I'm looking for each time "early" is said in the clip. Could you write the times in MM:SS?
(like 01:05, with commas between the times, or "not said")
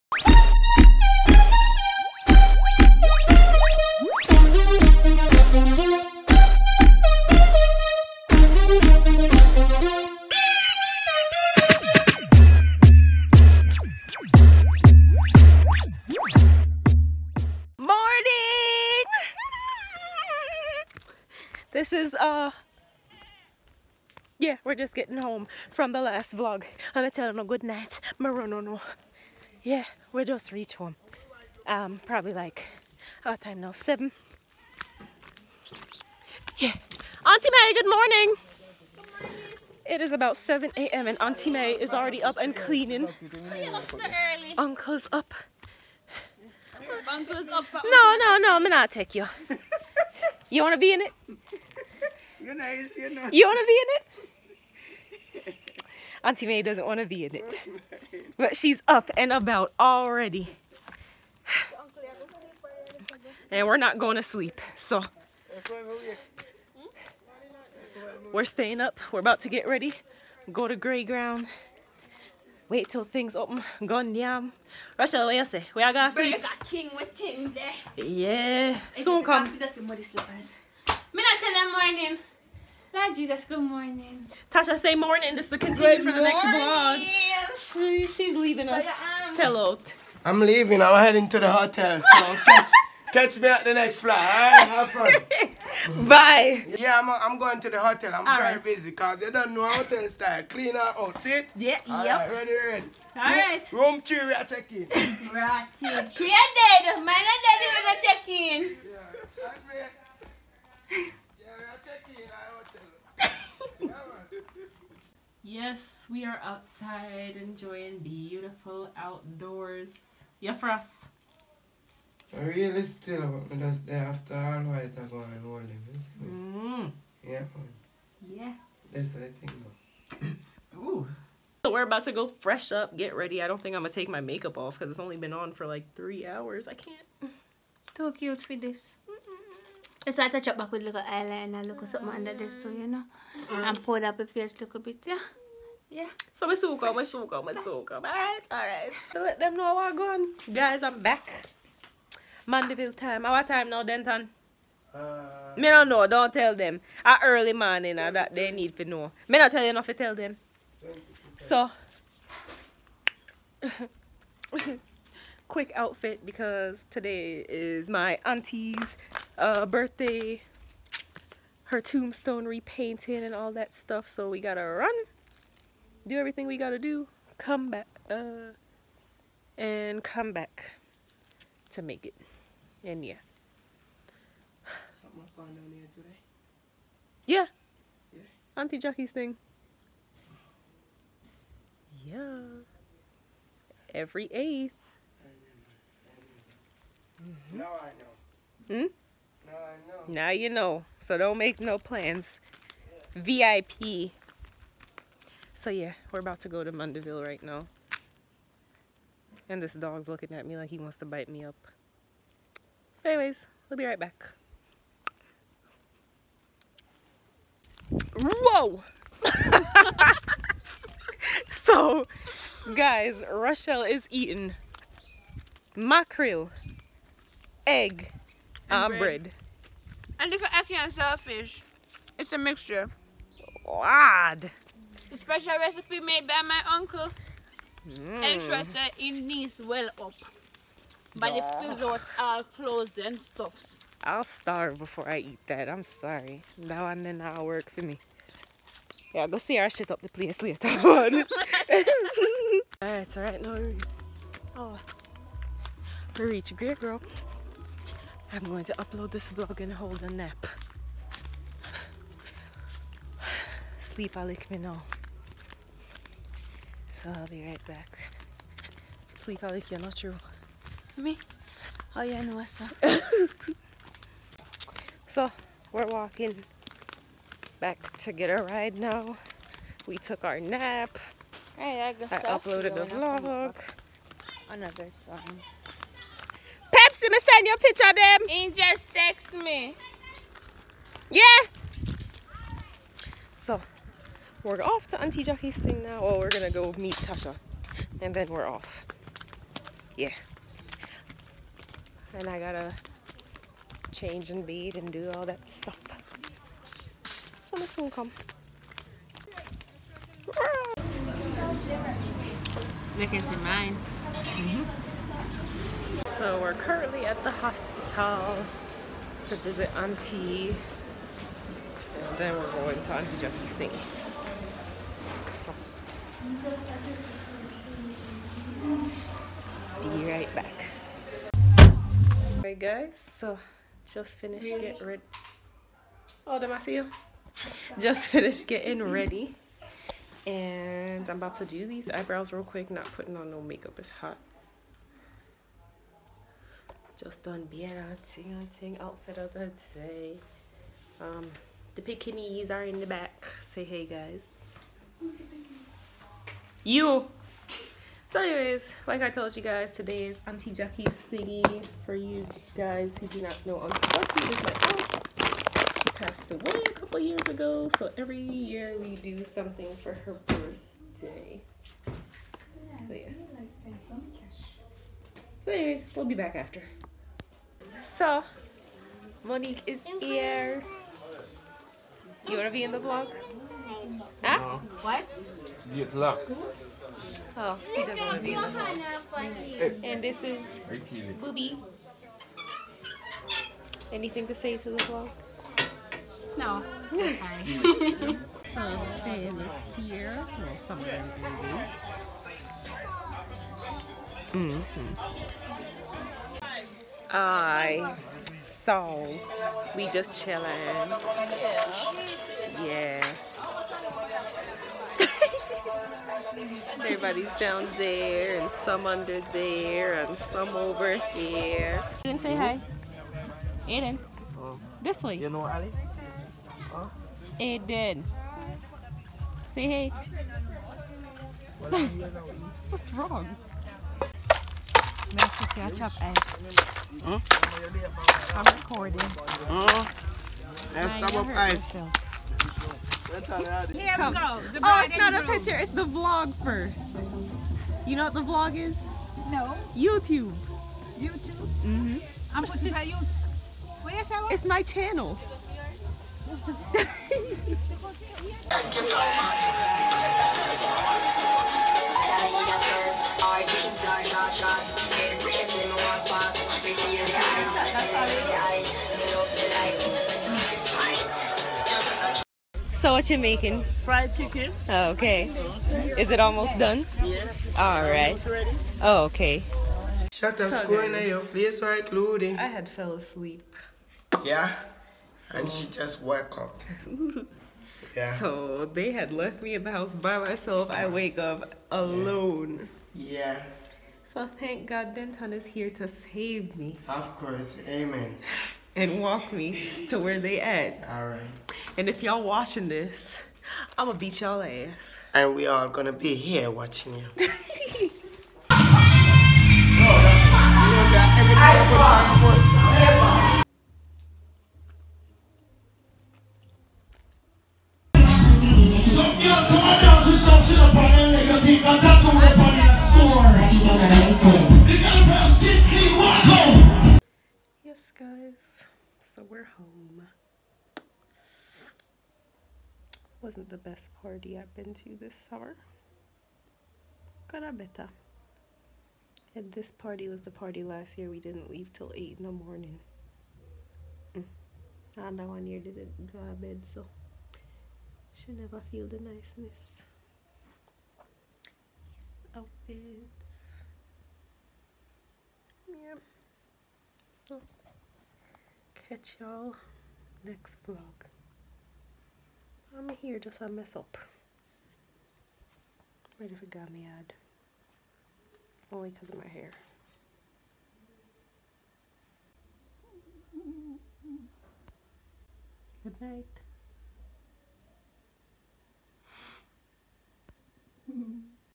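02:37.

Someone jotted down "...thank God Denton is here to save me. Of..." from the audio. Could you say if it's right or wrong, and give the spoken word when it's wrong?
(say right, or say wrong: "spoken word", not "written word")
right.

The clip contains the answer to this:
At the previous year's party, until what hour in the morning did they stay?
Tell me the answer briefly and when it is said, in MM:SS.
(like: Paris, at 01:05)
8, at 09:01.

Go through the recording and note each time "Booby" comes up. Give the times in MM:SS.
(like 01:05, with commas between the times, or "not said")
06:31.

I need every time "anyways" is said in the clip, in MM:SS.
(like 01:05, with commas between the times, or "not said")
03:33, 05:58, 06:15.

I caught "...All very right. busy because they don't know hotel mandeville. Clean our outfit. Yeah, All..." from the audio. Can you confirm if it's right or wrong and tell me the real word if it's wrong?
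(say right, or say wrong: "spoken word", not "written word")
wrong: "style", not "mandeville".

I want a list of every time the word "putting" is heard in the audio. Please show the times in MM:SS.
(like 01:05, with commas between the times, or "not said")
05:42, 07:32.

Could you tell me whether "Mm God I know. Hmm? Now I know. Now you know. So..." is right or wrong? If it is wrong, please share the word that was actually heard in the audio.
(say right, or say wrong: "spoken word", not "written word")
wrong: "Now", not "God".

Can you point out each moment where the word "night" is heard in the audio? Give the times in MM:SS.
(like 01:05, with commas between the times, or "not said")
00:27, 09:36.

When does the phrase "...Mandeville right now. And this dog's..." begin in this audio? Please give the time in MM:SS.
03:26.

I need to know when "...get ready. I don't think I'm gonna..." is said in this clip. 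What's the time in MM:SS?
02:12.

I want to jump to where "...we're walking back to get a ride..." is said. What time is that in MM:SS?
04:35.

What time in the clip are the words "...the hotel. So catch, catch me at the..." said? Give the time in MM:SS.
01:31.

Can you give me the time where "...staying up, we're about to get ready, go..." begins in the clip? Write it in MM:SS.
01:08.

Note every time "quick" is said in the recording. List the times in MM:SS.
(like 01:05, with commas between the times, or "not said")
02:45, 05:42.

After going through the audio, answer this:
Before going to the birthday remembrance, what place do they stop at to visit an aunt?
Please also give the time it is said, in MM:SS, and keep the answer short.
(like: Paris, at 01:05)
the hospital, at 05:17.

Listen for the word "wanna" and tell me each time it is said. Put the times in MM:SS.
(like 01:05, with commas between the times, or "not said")
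00:50, 00:56.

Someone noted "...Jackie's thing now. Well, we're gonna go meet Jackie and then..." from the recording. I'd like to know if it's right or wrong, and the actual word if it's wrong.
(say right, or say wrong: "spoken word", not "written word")
wrong: "Tasha", not "Jackie".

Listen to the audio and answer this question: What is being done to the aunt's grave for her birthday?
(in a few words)
tombstone repainted.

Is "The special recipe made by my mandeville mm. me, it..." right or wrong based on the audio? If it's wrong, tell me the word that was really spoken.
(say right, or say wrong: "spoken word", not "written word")
wrong: "uncle", not "mandeville".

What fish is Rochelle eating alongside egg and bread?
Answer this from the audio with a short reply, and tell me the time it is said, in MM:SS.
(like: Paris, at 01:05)
mackerel, at 03:45.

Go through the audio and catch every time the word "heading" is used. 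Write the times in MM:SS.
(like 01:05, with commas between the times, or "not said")
01:31.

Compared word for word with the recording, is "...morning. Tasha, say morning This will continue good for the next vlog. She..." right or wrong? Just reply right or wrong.
right.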